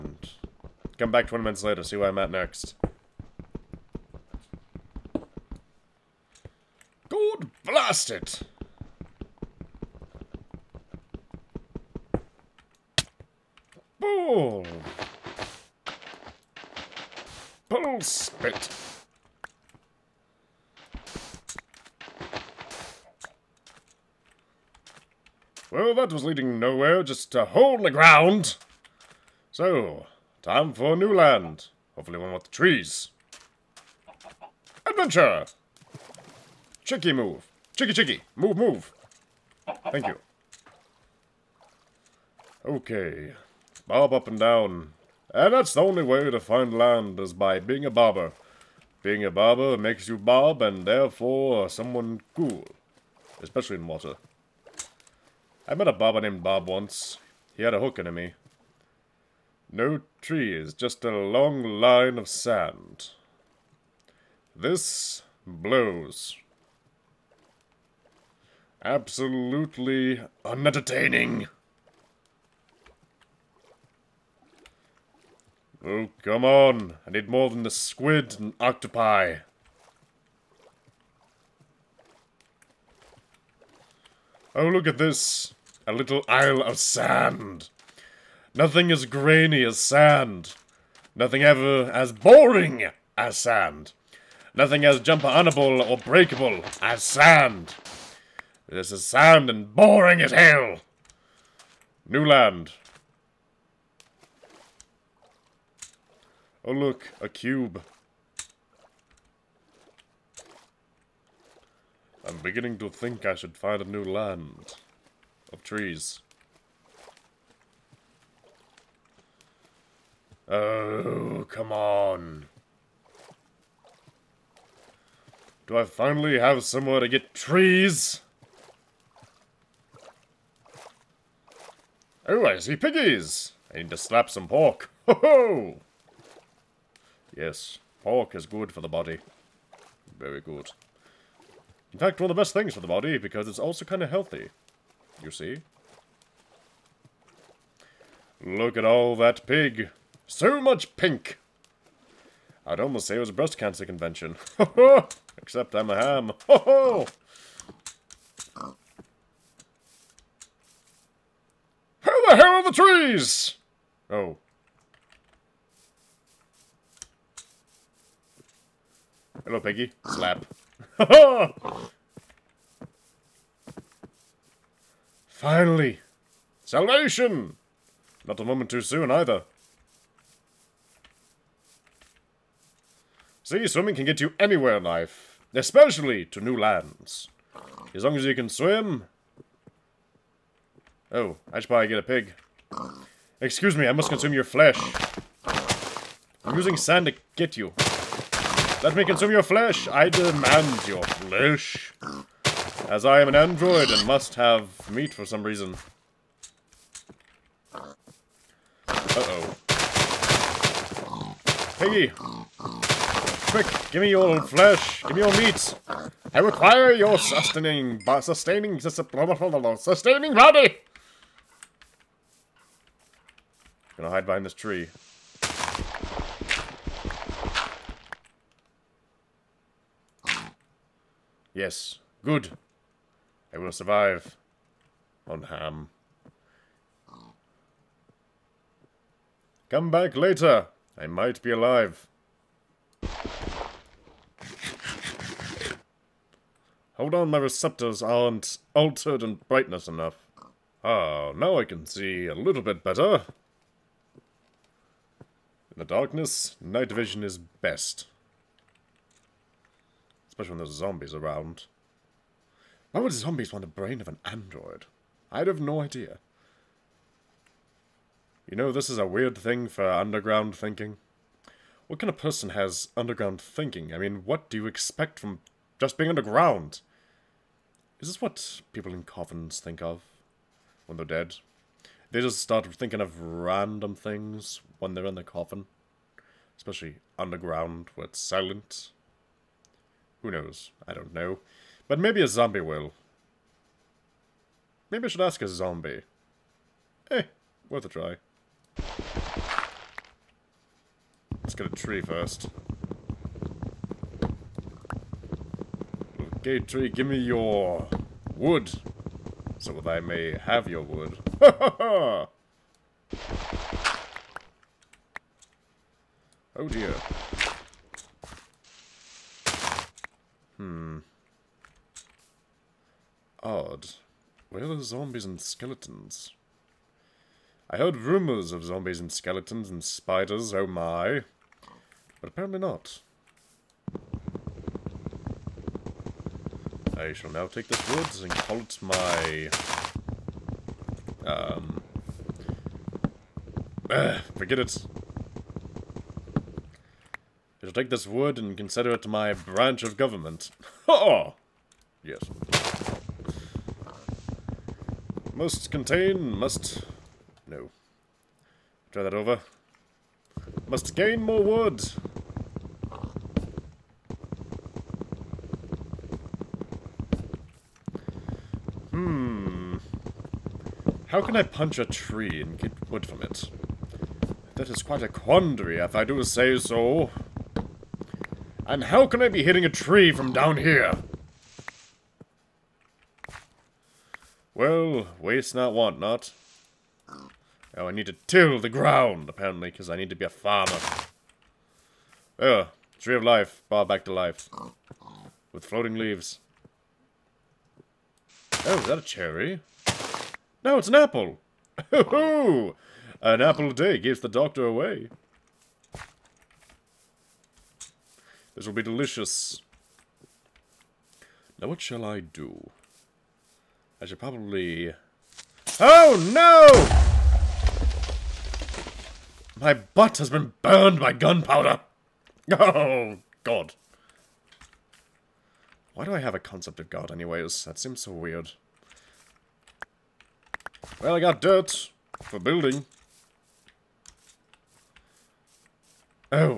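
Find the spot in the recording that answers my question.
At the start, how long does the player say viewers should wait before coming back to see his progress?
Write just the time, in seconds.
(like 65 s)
1 s.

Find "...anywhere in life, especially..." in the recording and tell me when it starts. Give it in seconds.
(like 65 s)
184 s.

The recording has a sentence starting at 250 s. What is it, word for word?
Ah, now I can see a little bit better.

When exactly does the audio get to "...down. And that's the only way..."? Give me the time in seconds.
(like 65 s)
44 s.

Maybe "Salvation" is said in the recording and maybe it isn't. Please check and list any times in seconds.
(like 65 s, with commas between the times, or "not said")
176 s.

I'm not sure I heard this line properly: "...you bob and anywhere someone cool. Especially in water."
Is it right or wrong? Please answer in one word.
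wrong.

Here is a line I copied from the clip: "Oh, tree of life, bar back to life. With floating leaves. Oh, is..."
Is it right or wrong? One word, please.
right.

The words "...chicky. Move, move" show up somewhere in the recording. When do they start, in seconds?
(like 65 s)
37 s.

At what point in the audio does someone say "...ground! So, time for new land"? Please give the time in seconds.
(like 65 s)
27 s.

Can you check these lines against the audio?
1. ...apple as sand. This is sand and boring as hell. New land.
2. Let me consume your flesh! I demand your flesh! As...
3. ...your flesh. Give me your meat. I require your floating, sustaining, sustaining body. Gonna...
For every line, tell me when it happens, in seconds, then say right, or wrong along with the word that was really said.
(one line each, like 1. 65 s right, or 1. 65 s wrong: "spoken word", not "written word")
1. 95 s wrong: "breakable", not "apple"
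2. 198 s right
3. 214 s wrong: "sustaining", not "floating".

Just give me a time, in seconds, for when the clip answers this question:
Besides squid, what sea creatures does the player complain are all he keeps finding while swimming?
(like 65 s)
78 s.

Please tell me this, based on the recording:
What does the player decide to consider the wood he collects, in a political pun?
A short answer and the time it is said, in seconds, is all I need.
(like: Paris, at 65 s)
branch of government, at 349 s.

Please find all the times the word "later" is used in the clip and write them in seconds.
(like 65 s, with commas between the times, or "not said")
1 s, 240 s.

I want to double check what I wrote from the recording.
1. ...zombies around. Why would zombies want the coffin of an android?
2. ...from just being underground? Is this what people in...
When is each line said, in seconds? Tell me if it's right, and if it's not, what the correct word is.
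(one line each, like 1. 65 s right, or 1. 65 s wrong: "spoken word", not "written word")
1. 260 s wrong: "brain", not "coffin"
2. 275 s right.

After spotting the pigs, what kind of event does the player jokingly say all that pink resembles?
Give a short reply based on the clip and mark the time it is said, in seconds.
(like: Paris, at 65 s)
breast cancer convention, at 153 s.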